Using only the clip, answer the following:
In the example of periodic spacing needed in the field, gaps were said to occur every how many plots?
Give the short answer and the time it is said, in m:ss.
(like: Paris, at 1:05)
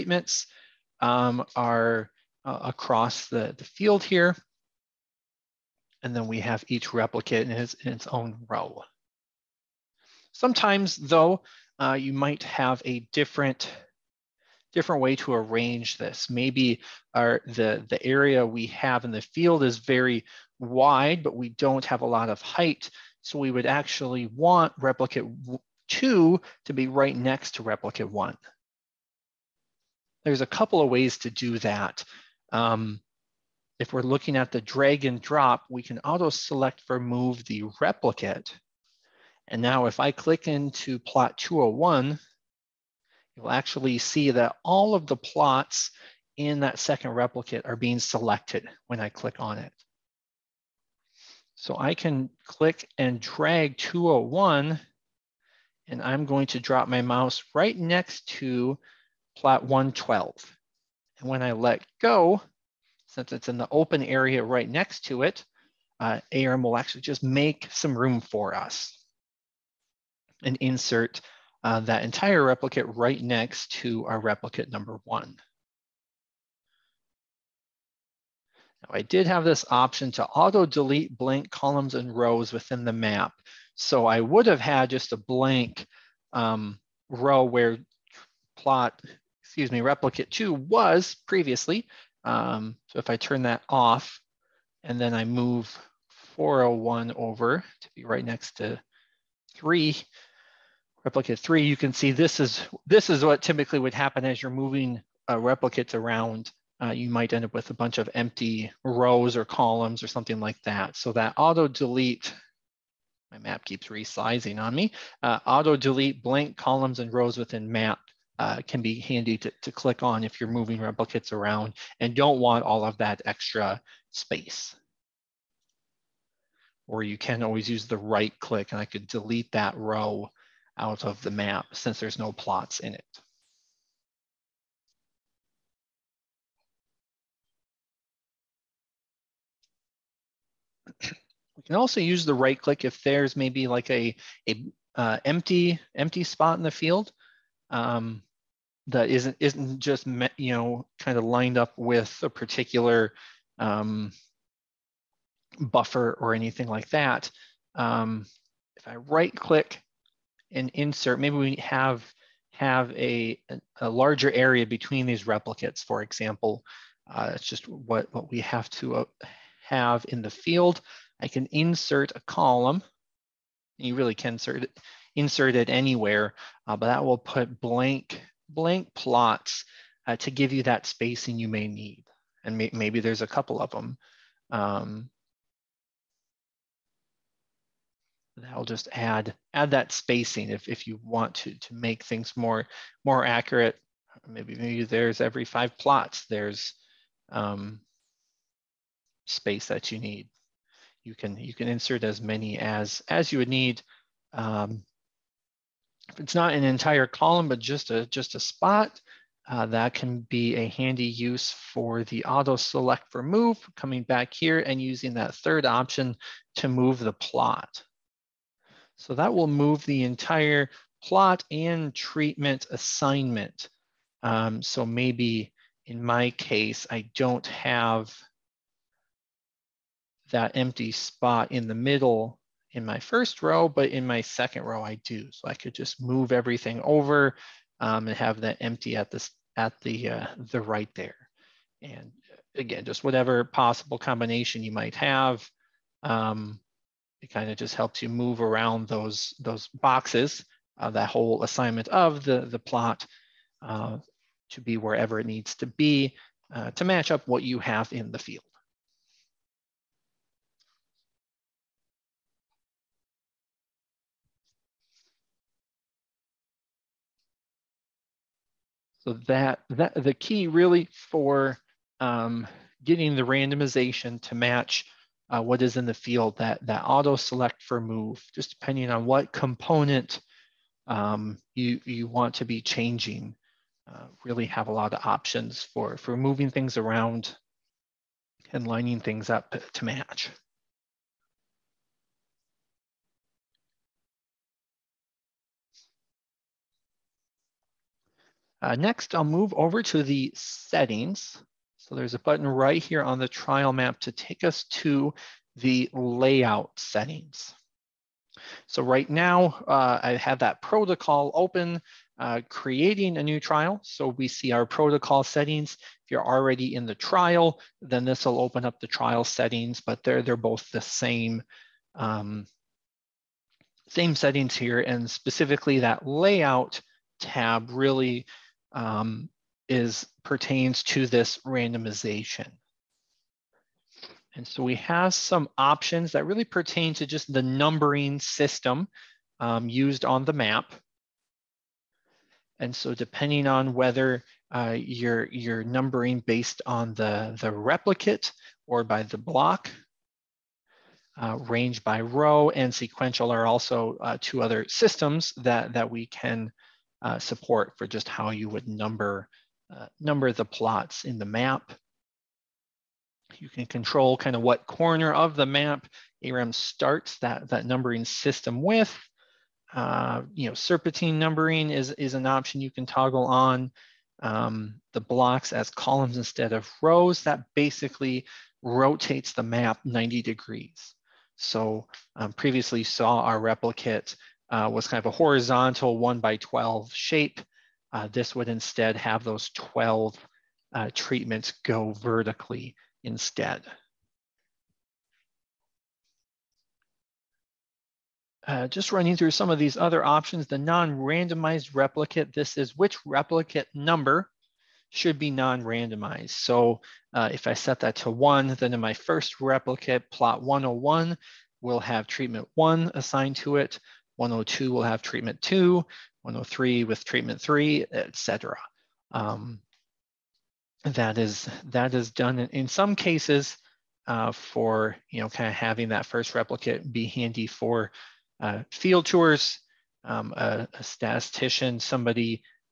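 5, at 3:15.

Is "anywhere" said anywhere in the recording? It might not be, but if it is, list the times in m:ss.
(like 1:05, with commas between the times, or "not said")
2:55.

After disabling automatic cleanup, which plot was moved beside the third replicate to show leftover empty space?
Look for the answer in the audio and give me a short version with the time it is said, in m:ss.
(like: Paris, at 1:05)
401, at 1:36.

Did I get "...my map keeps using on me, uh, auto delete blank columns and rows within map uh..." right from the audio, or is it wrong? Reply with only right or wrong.
wrong.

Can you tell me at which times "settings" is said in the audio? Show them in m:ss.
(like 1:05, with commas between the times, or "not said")
5:00, 5:06, 5:15, 5:19, 5:24.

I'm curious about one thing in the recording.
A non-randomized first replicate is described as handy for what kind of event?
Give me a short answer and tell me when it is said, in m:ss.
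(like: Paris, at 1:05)
Field tours, at 7:08.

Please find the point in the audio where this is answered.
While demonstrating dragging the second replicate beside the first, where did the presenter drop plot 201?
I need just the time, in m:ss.
0:59.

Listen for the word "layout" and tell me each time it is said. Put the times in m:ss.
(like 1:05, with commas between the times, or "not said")
5:05, 5:26.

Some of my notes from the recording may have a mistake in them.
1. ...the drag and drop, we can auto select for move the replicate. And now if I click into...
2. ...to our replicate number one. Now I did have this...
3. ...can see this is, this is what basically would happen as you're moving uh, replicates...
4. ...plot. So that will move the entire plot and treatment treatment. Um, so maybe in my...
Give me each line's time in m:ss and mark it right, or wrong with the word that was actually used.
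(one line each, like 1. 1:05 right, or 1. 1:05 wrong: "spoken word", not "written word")
1. 0:34 right
2. 1:13 right
3. 1:41 wrong: "typically", not "basically"
4. 3:37 wrong: "assignment", not "treatment".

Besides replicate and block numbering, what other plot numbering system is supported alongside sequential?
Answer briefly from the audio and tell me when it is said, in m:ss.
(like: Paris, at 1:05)
Range by row, at 5:51.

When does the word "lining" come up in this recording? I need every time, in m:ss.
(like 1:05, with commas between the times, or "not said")
4:48.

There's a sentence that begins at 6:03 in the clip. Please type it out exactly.
You can control kind of what corner of the map ARM starts that, that numbering system with.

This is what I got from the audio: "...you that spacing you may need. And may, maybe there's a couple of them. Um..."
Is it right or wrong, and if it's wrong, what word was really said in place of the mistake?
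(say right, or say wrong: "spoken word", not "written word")
right.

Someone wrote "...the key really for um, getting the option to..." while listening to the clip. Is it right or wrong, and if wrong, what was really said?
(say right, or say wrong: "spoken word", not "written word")
wrong: "randomization", not "option".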